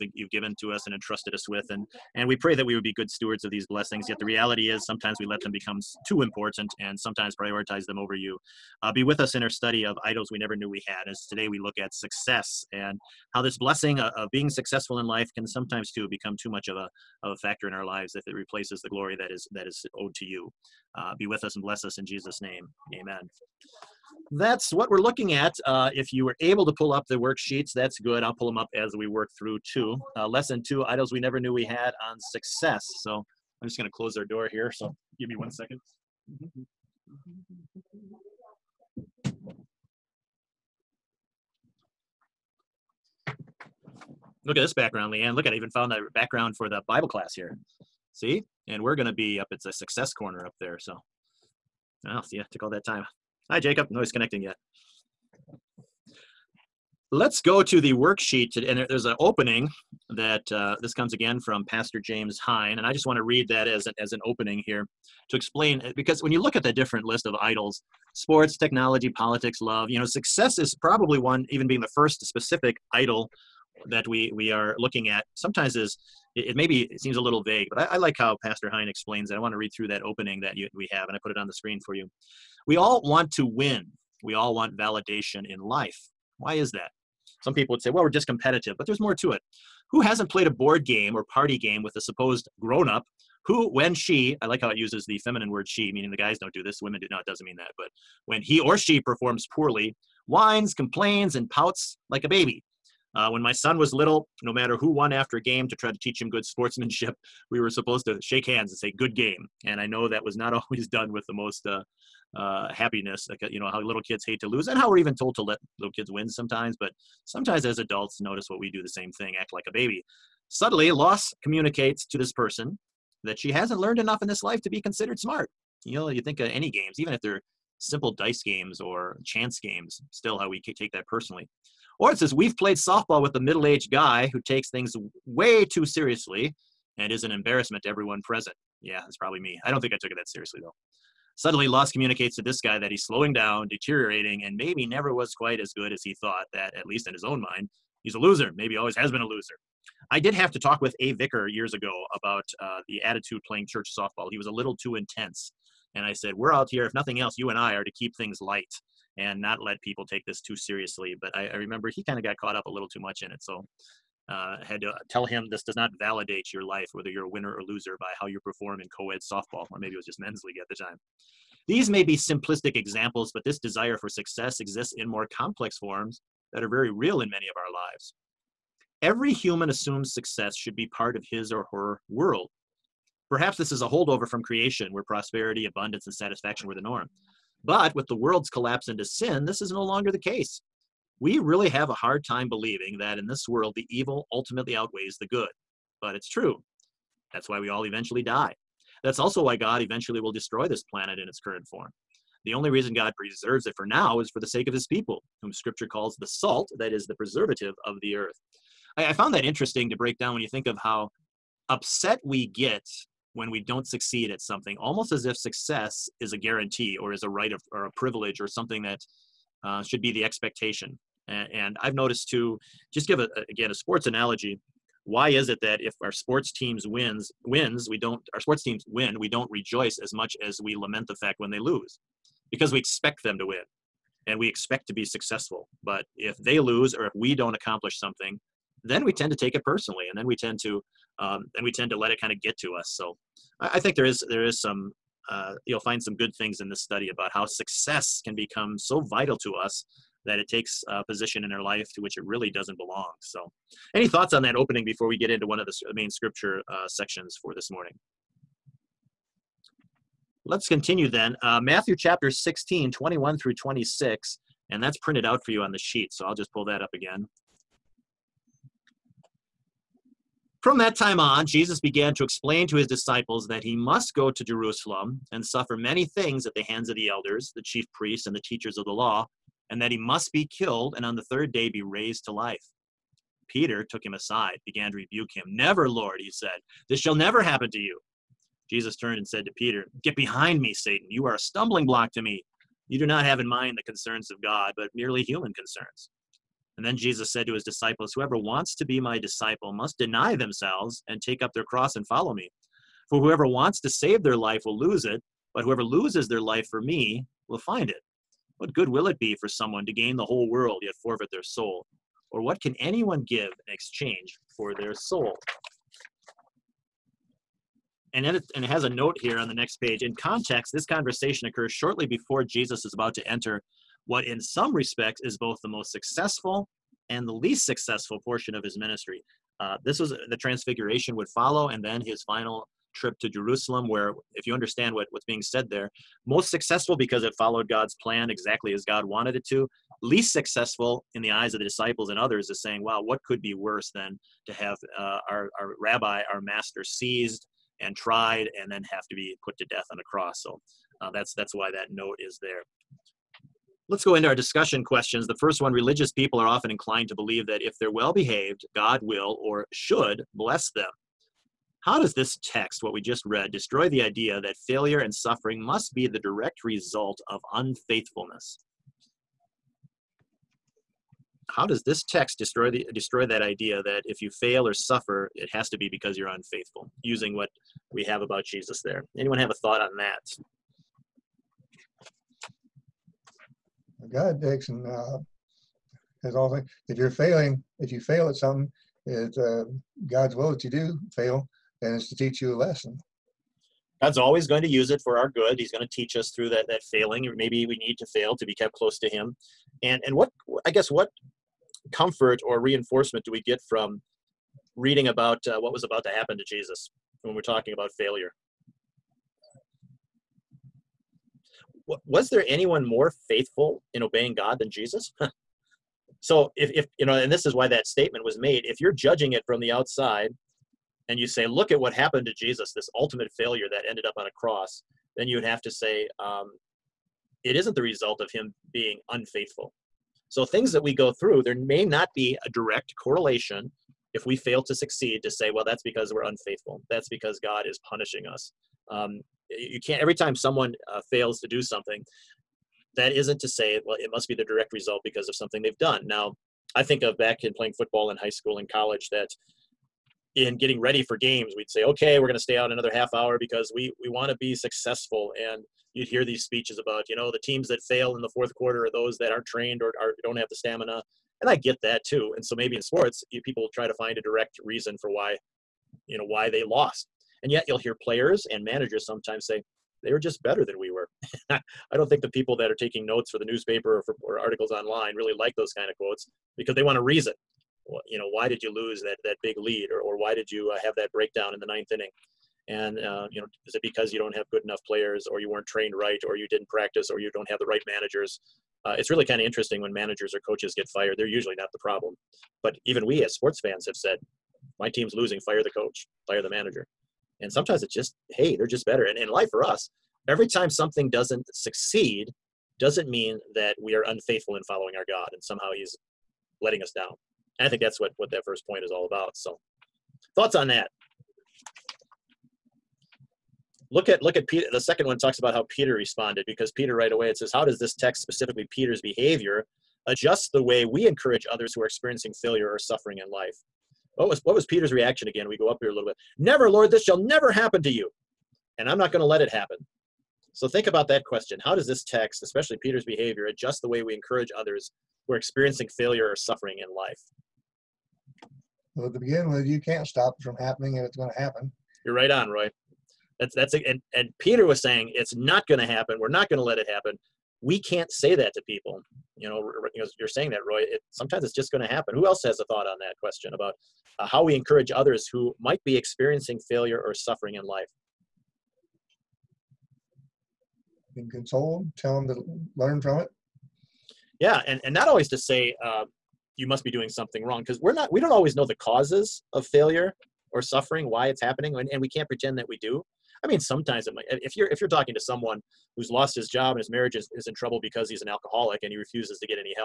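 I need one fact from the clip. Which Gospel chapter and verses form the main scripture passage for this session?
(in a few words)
Matthew 16:21-26.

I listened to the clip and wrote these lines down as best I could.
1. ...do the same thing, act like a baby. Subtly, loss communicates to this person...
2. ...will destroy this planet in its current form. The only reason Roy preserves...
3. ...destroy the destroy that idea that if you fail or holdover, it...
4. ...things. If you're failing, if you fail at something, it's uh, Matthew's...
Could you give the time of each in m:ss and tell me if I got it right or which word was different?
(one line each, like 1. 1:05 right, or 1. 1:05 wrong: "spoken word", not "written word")
1. 1:58 right
2. 3:20 wrong: "God", not "Roy"
3. 6:12 wrong: "suffer", not "holdover"
4. 6:26 wrong: "God", not "Matthew".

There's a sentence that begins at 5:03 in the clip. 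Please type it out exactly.
For whoever wants to save their life will lose it, but whoever loses their life for me will find it.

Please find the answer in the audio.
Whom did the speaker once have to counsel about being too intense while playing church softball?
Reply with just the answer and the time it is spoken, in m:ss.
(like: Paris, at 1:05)
A Vicar, at 2:30.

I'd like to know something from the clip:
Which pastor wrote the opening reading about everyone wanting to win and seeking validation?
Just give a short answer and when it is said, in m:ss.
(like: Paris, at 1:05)
James Hine, at 1:01.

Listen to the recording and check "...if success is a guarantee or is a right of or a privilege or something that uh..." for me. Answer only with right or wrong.
right.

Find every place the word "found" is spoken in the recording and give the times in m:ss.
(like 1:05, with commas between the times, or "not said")
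0:45, 3:29.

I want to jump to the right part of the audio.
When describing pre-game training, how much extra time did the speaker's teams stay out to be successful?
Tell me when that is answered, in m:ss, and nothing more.
7:32.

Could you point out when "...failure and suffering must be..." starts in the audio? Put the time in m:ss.
6:04.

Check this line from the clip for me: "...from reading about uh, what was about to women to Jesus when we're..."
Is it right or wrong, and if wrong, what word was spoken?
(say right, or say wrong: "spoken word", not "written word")
wrong: "happen", not "women".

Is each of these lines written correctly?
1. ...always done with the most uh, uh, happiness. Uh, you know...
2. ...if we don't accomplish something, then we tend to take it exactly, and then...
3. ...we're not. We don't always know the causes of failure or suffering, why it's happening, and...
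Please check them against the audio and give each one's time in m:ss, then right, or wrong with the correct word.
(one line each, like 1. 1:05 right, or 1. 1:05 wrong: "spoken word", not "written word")
1. 1:50 right
2. 3:57 wrong: "personally", not "exactly"
3. 9:27 right.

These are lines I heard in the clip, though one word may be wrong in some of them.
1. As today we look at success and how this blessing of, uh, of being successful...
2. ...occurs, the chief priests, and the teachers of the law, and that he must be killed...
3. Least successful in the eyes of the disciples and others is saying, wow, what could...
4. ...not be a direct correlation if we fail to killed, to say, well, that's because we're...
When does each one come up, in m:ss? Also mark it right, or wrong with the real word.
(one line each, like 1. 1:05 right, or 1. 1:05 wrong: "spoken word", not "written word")
1. 0:11 right
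2. 4:37 wrong: "elders", not "occurs"
3. 5:40 right
4. 7:11 wrong: "succeed", not "killed".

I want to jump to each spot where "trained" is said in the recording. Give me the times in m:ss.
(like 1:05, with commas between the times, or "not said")
7:39, 8:05.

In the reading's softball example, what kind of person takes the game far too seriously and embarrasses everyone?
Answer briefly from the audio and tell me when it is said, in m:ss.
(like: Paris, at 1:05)
Middle aged guy, at 2:13.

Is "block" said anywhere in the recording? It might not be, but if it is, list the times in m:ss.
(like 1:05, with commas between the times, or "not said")
4:51.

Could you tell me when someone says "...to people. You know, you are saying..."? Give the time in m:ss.
9:08.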